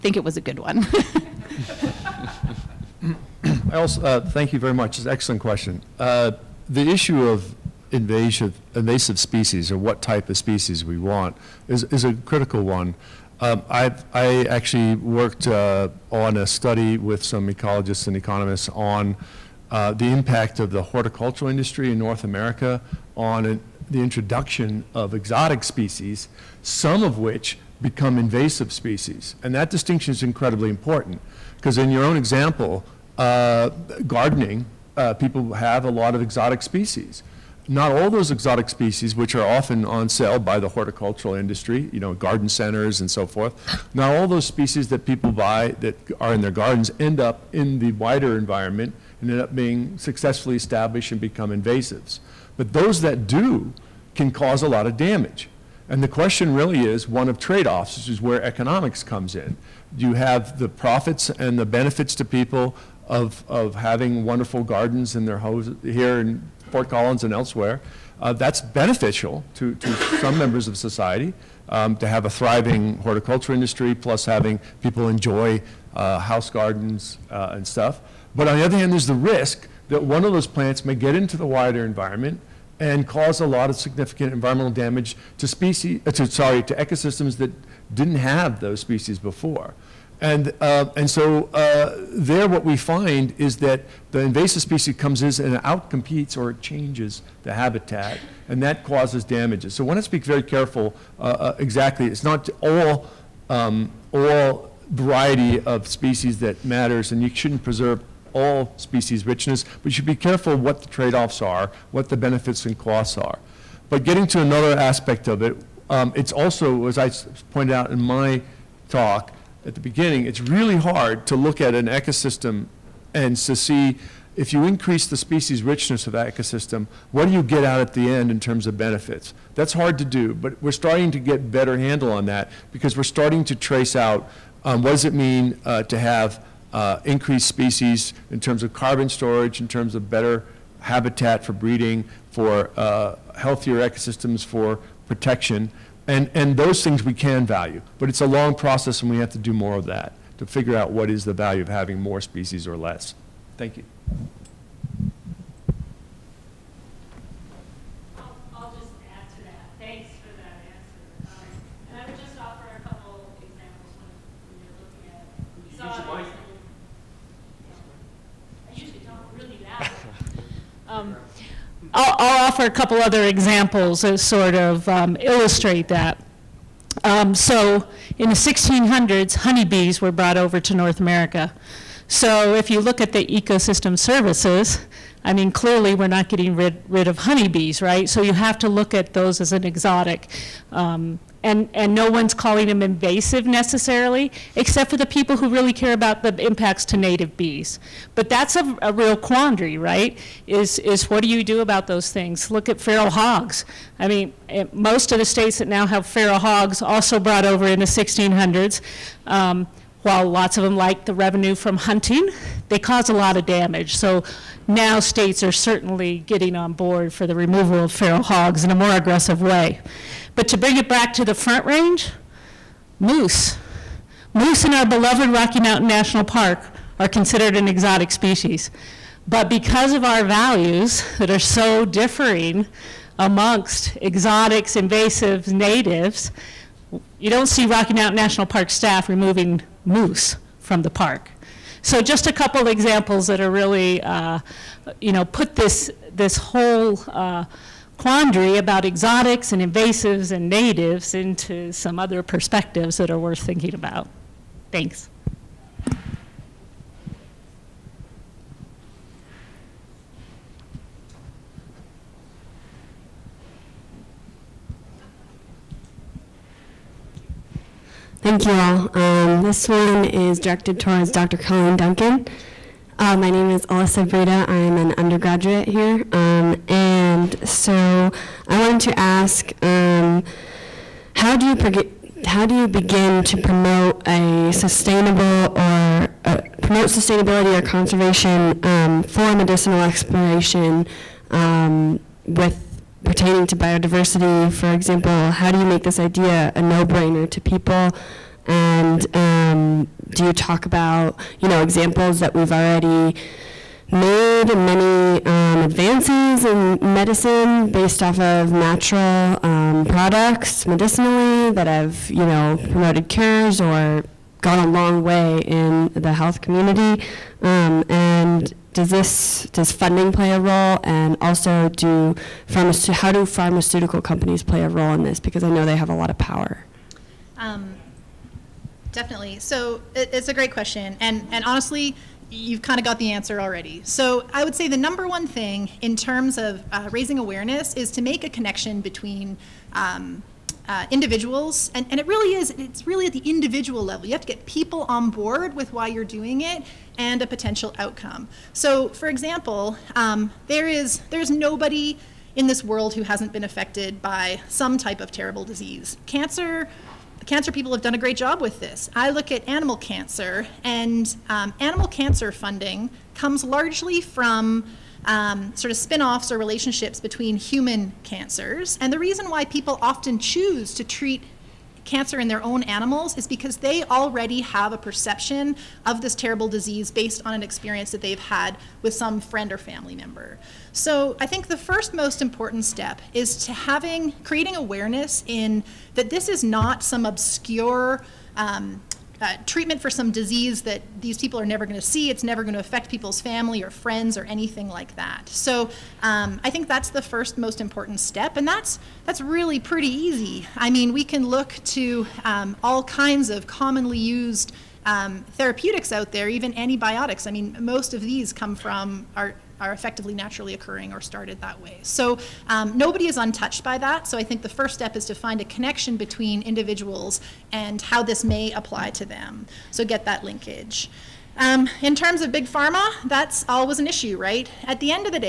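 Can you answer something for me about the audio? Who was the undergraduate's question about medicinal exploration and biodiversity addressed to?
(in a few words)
Dr. Colleen Duncan.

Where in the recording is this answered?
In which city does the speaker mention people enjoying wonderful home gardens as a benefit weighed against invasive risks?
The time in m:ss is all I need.
1:06.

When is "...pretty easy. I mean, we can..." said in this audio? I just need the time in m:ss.
6:39.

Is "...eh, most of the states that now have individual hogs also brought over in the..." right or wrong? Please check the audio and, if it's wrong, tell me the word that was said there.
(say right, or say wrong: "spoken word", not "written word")
wrong: "feral", not "individual".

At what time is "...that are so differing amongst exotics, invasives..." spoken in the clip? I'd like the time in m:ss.
3:51.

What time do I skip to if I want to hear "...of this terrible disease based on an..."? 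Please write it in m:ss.
6:15.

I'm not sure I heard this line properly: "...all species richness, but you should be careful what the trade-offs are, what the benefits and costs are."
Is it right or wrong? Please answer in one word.
right.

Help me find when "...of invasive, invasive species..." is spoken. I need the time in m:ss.
0:07.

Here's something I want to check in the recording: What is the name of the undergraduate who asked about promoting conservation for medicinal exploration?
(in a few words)
Alyssa Breda.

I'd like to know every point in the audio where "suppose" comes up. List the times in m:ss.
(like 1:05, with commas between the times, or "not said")
not said.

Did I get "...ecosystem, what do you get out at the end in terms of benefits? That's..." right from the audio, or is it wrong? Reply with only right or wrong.
right.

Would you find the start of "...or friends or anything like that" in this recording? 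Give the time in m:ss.
6:33.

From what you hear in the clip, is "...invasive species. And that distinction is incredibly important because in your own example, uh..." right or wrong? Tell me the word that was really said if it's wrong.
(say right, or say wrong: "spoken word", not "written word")
right.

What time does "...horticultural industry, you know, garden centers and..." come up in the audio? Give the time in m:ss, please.
0:40.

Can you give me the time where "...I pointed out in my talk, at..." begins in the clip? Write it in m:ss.
1:56.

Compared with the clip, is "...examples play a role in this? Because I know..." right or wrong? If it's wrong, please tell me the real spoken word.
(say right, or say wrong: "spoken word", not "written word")
wrong: "companies", not "examples".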